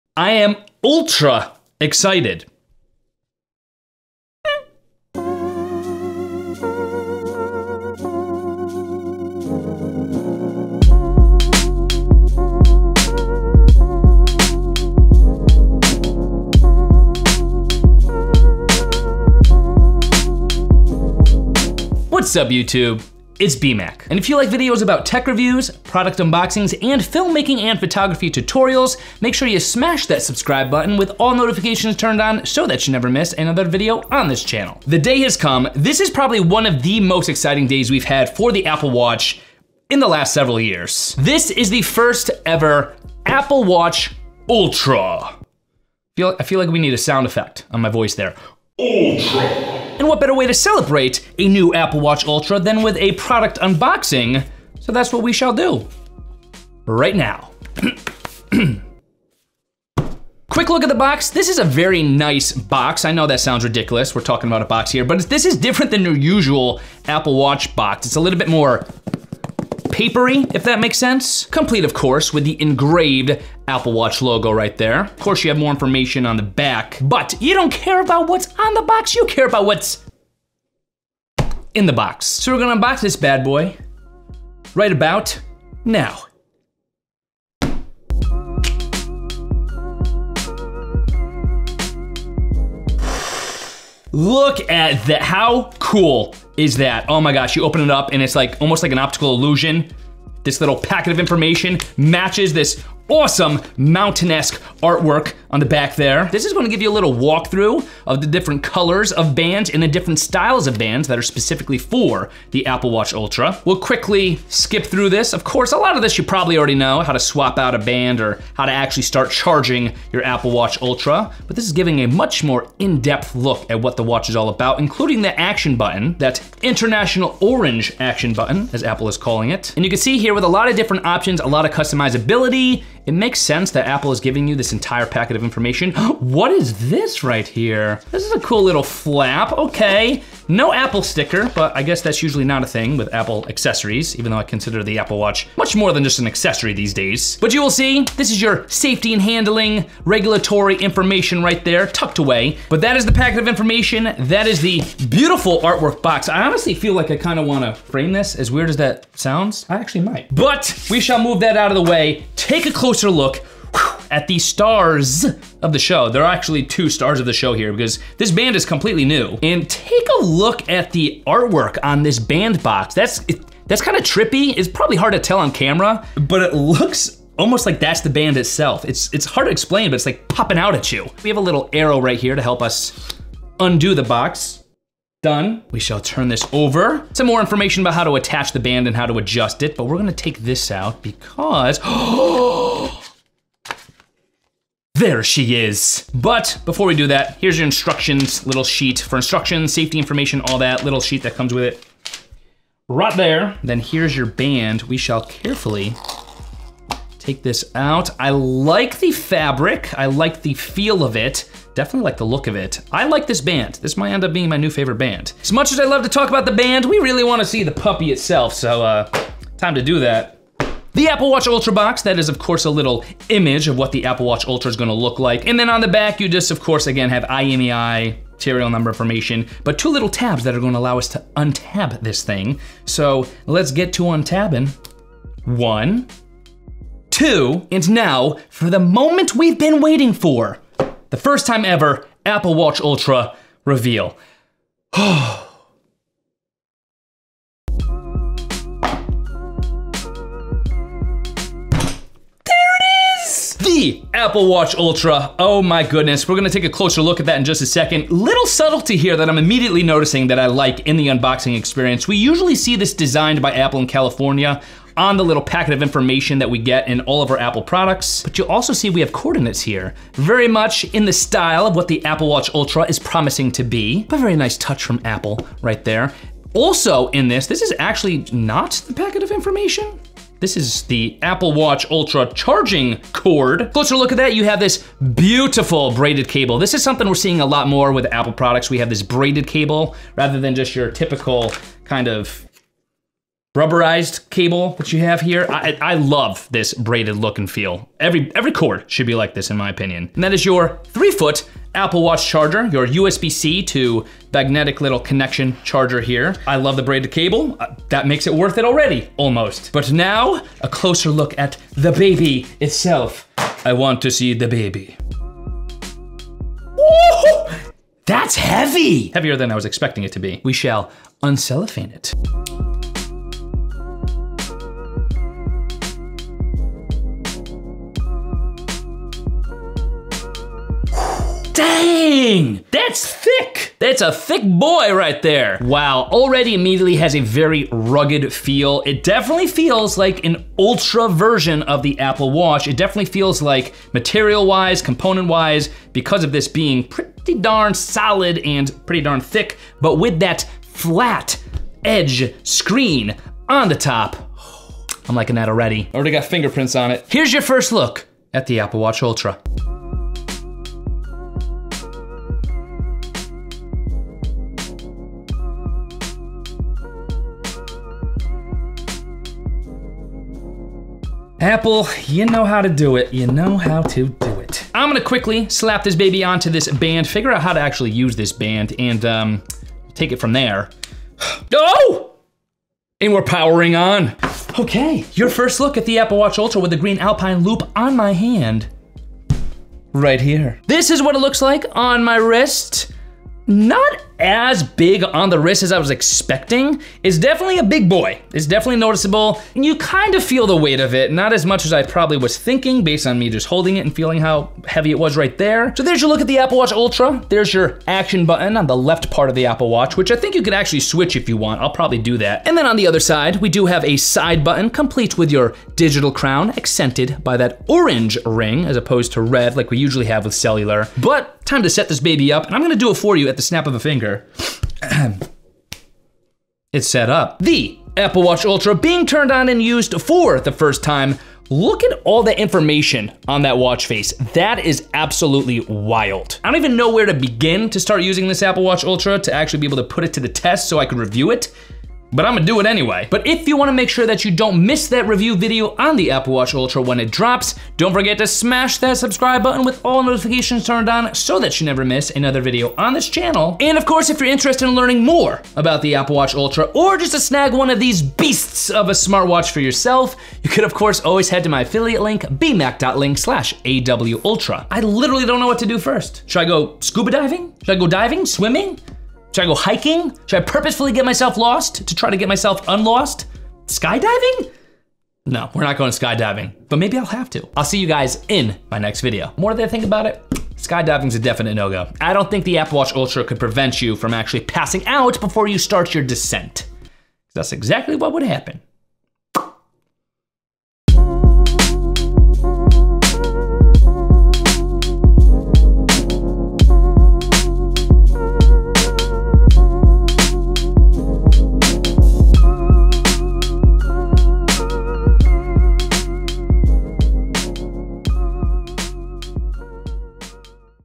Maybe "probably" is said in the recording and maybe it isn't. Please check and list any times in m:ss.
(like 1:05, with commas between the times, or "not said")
0:36, 1:56, 2:54, 6:41, 6:51.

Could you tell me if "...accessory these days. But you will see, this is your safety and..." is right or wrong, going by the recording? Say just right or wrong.
right.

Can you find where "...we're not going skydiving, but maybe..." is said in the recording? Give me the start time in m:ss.
7:55.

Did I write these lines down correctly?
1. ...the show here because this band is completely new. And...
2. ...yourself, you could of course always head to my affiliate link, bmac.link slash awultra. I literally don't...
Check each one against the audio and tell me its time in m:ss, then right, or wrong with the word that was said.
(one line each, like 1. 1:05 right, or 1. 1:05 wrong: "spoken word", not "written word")
1. 2:47 right
2. 7:39 right.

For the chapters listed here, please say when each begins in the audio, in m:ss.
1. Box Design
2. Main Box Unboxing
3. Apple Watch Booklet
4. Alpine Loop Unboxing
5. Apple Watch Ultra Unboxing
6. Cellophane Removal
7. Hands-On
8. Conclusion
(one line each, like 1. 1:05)
1. 1:00
2. 1:27
3. 1:46
4. 2:49
5. 3:40
6. 5:21
7. 6:30
8. 7:15.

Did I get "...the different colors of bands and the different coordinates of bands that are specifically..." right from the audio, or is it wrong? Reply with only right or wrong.
wrong.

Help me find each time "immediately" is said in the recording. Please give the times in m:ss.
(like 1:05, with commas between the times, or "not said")
4:19, 5:36.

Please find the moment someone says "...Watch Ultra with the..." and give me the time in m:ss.
6:26.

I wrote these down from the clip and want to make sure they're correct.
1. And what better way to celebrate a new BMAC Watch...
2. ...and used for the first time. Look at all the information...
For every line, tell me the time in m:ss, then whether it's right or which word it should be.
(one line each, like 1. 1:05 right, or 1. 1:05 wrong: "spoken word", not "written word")
1. 0:49 wrong: "Apple", not "BMAC"
2. 7:09 right.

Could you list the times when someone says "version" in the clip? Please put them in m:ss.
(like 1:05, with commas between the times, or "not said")
5:41.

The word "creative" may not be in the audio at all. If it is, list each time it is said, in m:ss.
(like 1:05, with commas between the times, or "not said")
not said.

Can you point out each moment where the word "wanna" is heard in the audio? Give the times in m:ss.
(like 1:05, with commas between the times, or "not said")
3:37, 7:23.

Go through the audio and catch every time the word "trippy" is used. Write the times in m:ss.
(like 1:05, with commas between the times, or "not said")
2:54.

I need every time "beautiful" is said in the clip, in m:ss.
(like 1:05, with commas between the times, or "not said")
2:35, 4:45.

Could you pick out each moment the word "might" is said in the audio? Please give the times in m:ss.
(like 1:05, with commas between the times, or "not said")
2:40, 3:33.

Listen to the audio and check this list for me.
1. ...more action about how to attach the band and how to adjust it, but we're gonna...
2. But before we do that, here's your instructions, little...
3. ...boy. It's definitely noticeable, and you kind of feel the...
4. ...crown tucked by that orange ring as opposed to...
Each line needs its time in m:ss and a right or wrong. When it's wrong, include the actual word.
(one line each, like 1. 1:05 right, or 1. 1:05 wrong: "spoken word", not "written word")
1. 3:07 wrong: "information", not "action"
2. 3:16 right
3. 6:37 right
4. 6:56 wrong: "accented", not "tucked".